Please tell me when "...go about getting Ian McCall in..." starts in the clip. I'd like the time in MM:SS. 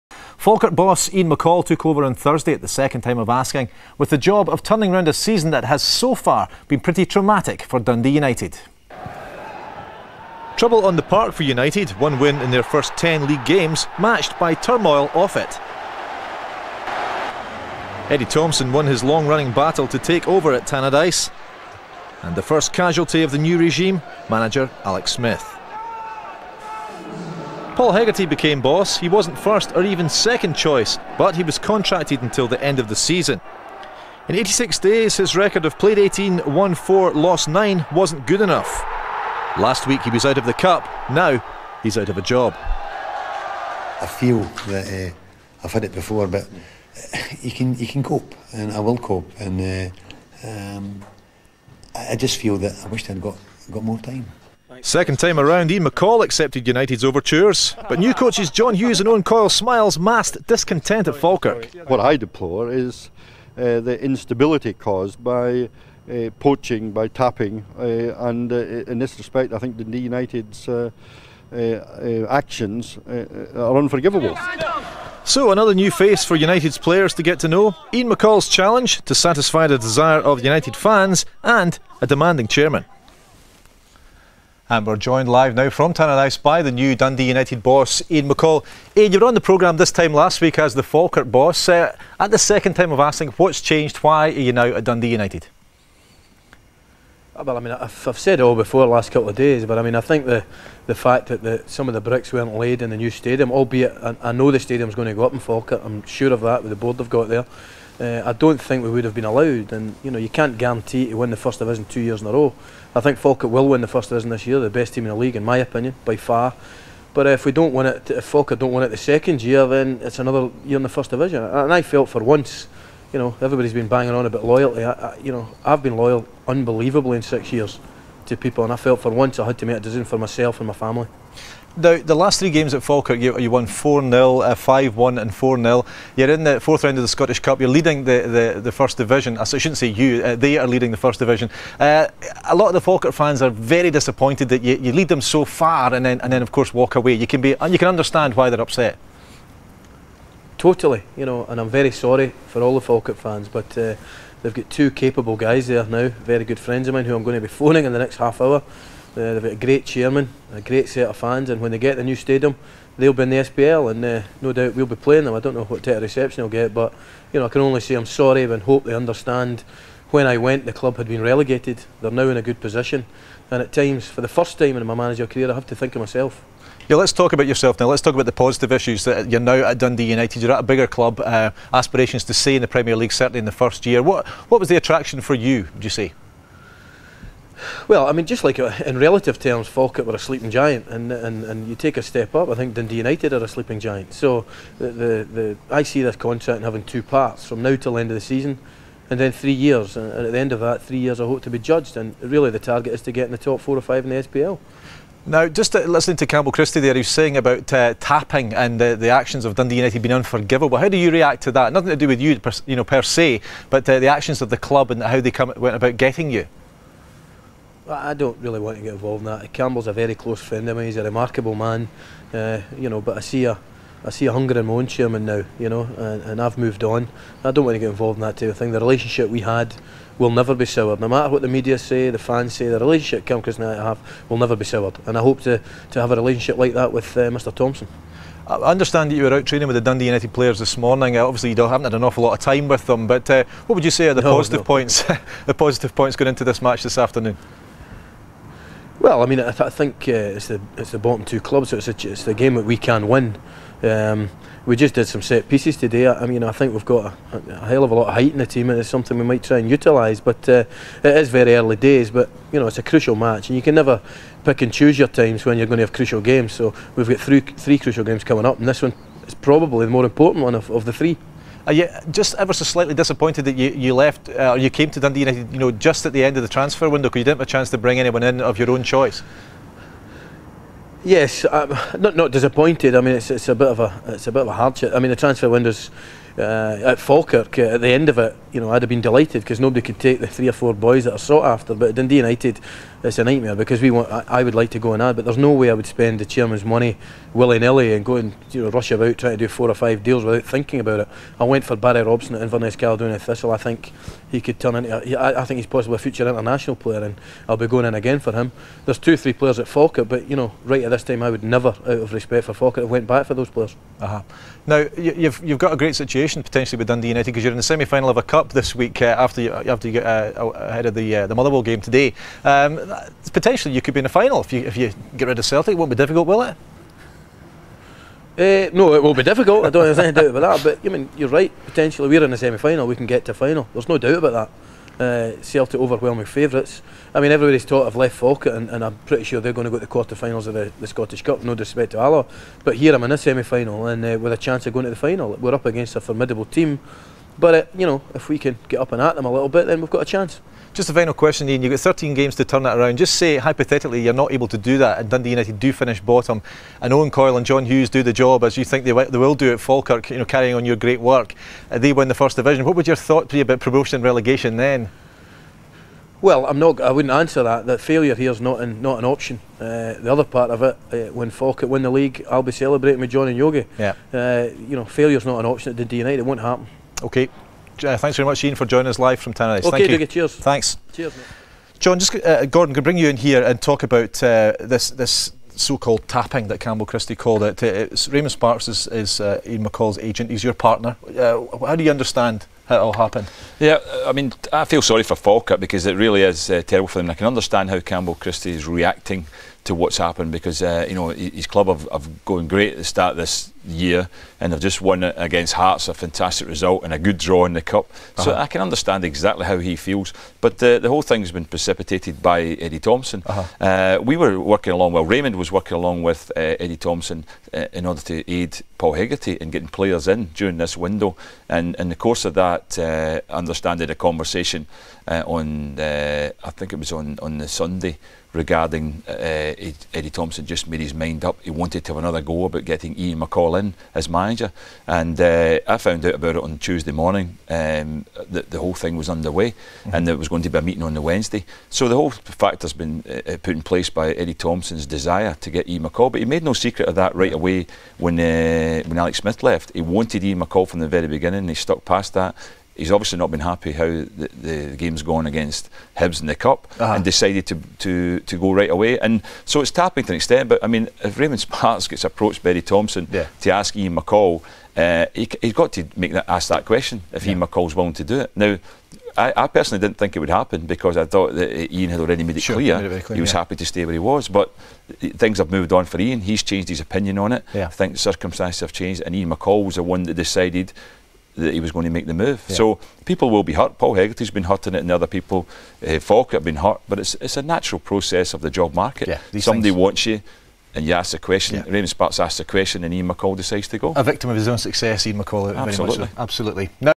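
07:12.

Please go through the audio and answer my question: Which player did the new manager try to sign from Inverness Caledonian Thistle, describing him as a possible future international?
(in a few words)
Barry Robson.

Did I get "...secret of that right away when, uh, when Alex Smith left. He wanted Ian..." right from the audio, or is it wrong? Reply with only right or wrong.
right.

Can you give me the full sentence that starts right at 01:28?
Ian, you were on the programme this time last week as the Falkirk boss.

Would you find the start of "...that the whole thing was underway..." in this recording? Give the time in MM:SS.
07:18.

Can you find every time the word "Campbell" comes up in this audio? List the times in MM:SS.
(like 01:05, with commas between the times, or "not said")
03:26, 03:39, 06:26, 06:37.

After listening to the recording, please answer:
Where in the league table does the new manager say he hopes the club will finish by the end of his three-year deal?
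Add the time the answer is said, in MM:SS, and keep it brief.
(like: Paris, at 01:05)
top four or five, at 03:23.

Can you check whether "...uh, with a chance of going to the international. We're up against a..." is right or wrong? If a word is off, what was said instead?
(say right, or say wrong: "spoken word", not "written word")
wrong: "final", not "international".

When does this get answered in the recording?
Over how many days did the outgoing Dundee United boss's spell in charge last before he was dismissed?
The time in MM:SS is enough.
00:34.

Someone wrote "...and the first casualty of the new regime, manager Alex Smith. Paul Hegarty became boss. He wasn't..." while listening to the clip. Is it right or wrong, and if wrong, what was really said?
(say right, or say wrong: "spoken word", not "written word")
right.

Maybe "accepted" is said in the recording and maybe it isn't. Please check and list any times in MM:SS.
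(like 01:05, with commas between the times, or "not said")
00:56.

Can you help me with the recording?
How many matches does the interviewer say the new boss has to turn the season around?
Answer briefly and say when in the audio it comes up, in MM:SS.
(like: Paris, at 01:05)
13, at 05:51.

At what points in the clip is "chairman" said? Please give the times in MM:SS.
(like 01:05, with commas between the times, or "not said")
01:22, 02:39, 03:44, 04:56.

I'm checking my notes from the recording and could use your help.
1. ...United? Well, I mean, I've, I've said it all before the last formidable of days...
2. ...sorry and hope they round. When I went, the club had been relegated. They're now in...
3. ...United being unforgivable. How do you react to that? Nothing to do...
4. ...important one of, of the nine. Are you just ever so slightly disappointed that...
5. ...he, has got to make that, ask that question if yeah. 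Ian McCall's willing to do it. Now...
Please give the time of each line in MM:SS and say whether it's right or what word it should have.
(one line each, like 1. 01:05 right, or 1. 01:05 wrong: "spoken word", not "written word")
1. 01:35 wrong: "couple", not "formidable"
2. 02:48 wrong: "understand", not "round"
3. 03:29 right
4. 04:30 wrong: "three", not "nine"
5. 07:45 right.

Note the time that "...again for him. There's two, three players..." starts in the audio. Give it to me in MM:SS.
05:07.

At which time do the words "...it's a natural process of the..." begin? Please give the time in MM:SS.
08:07.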